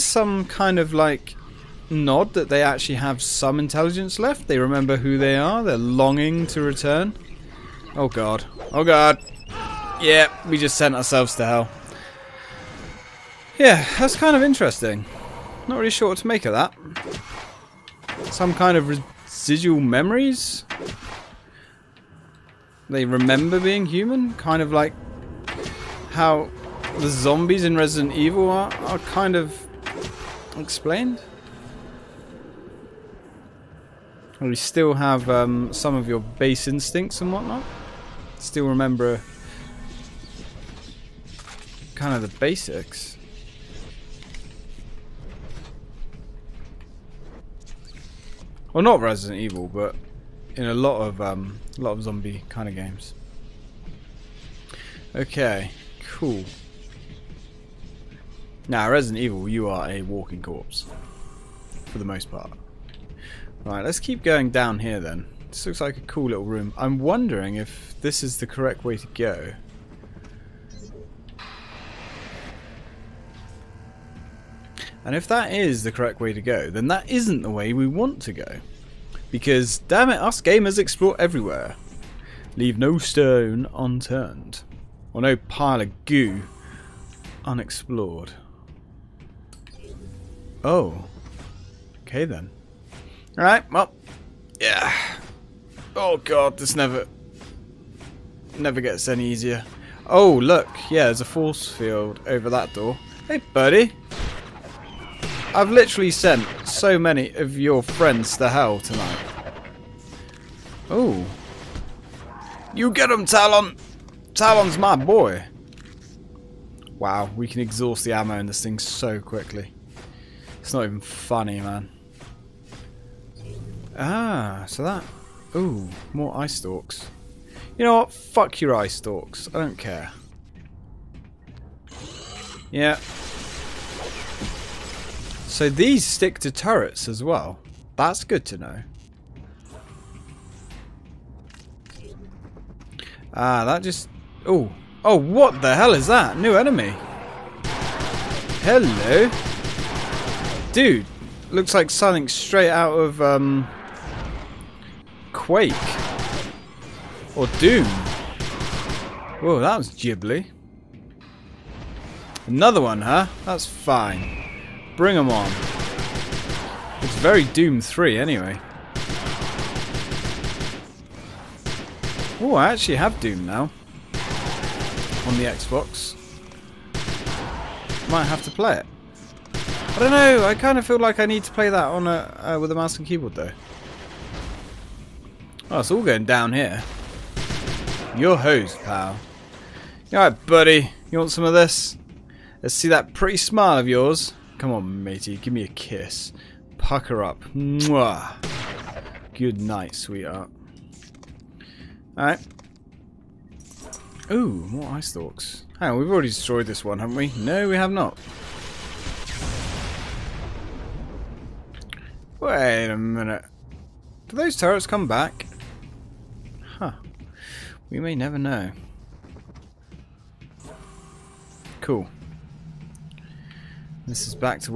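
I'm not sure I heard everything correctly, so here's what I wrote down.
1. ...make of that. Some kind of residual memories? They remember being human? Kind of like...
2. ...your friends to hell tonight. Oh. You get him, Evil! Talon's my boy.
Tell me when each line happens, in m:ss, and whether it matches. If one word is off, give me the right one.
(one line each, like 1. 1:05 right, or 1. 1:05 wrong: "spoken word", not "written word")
1. 0:16 right
2. 1:47 wrong: "Talon", not "Evil".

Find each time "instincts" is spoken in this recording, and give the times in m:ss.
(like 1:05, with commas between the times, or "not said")
0:36.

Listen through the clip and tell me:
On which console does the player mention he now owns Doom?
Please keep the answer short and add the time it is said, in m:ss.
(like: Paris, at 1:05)
Xbox, at 2:55.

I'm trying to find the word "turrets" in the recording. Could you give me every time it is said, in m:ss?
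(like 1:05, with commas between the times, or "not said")
2:16, 3:34.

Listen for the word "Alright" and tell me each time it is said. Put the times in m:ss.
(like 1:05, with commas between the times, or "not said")
1:33, 3:10, 3:22.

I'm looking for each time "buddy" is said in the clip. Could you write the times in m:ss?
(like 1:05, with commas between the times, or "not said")
1:43, 3:10.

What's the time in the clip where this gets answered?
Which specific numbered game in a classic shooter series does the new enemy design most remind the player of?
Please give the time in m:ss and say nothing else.
2:47.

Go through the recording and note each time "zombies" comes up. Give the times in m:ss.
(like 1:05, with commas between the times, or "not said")
0:27, 0:52.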